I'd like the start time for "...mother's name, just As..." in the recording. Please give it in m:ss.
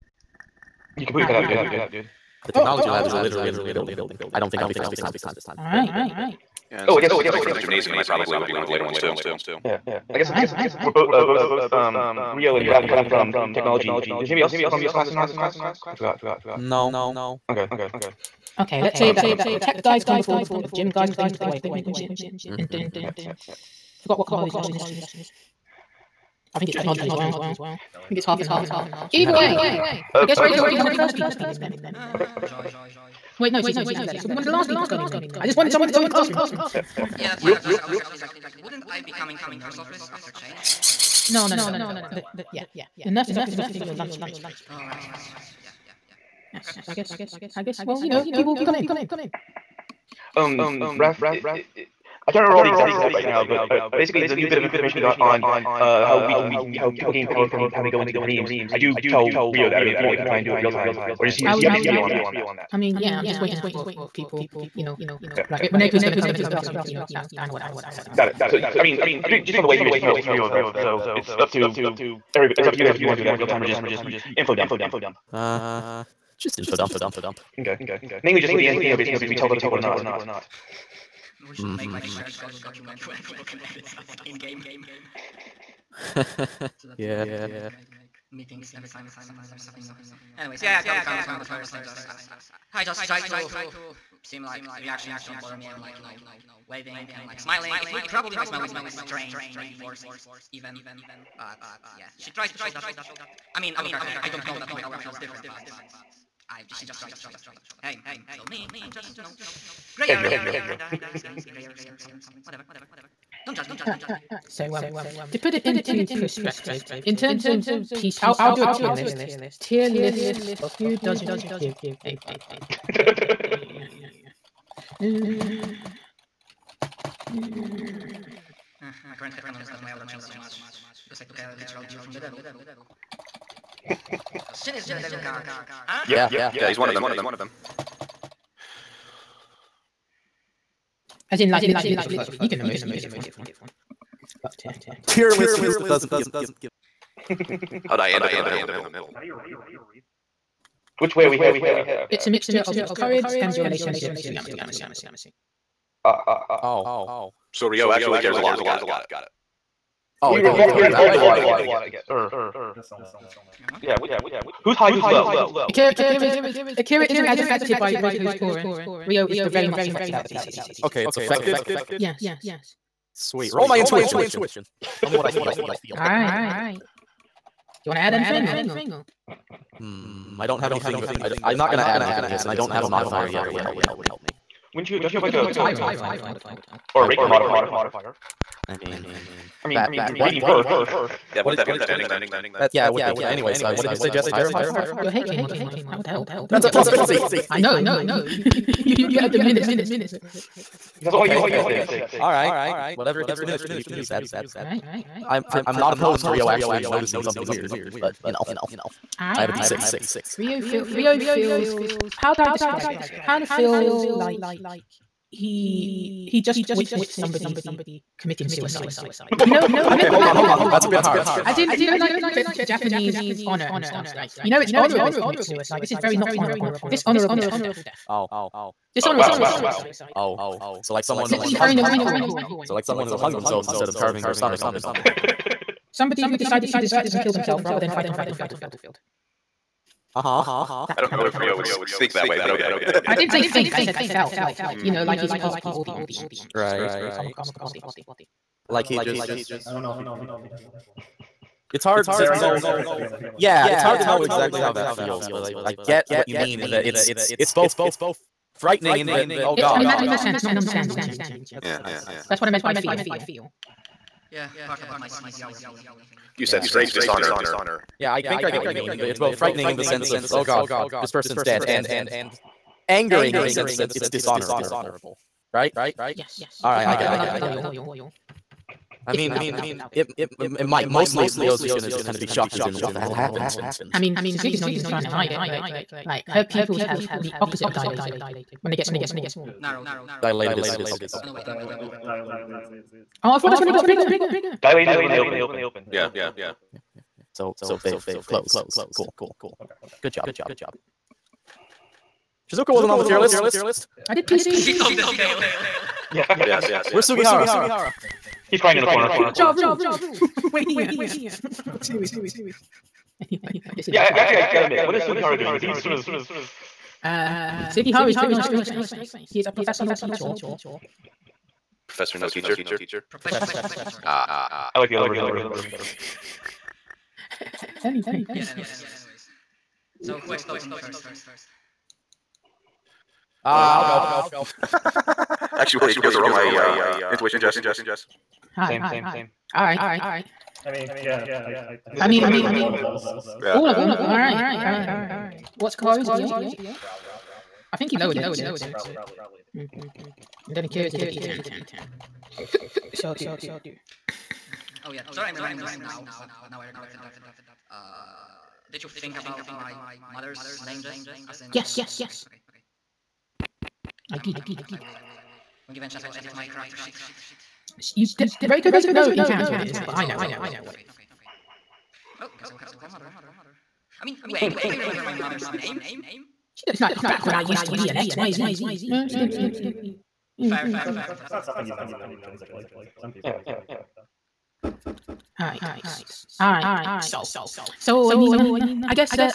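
6:00.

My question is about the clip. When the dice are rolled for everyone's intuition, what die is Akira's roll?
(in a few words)
D10.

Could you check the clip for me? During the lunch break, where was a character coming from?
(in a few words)
The nurse's office.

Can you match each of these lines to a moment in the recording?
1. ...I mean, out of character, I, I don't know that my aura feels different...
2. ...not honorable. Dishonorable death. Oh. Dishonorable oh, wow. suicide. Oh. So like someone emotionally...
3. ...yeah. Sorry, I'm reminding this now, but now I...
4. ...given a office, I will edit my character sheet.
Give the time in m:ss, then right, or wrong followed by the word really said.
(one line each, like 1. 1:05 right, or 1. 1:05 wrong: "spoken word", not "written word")
1. 1:43 right
2. 3:46 wrong: "literally", not "emotionally"
3. 5:54 right
4. 6:05 wrong: "chance", not "office".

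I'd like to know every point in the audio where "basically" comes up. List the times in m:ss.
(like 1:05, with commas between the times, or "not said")
0:53, 1:09, 1:18.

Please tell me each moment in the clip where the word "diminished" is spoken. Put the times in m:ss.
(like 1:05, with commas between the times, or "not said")
3:19, 3:23.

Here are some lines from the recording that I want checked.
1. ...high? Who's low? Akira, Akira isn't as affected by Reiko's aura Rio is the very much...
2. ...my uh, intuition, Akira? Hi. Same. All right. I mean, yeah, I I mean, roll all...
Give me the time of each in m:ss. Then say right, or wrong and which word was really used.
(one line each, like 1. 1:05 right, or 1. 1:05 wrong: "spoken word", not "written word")
1. 2:44 right
2. 5:36 wrong: "Jess", not "Akira".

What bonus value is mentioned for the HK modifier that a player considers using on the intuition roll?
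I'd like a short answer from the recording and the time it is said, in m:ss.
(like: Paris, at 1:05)
plus 50, at 3:16.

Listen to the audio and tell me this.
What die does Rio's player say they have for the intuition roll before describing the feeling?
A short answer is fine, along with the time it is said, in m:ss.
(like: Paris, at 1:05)
D6, at 3:29.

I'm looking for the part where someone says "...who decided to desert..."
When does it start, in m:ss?
3:56.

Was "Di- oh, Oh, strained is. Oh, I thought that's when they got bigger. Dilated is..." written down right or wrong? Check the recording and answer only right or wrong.
wrong.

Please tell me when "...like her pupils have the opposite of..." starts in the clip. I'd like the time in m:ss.
4:46.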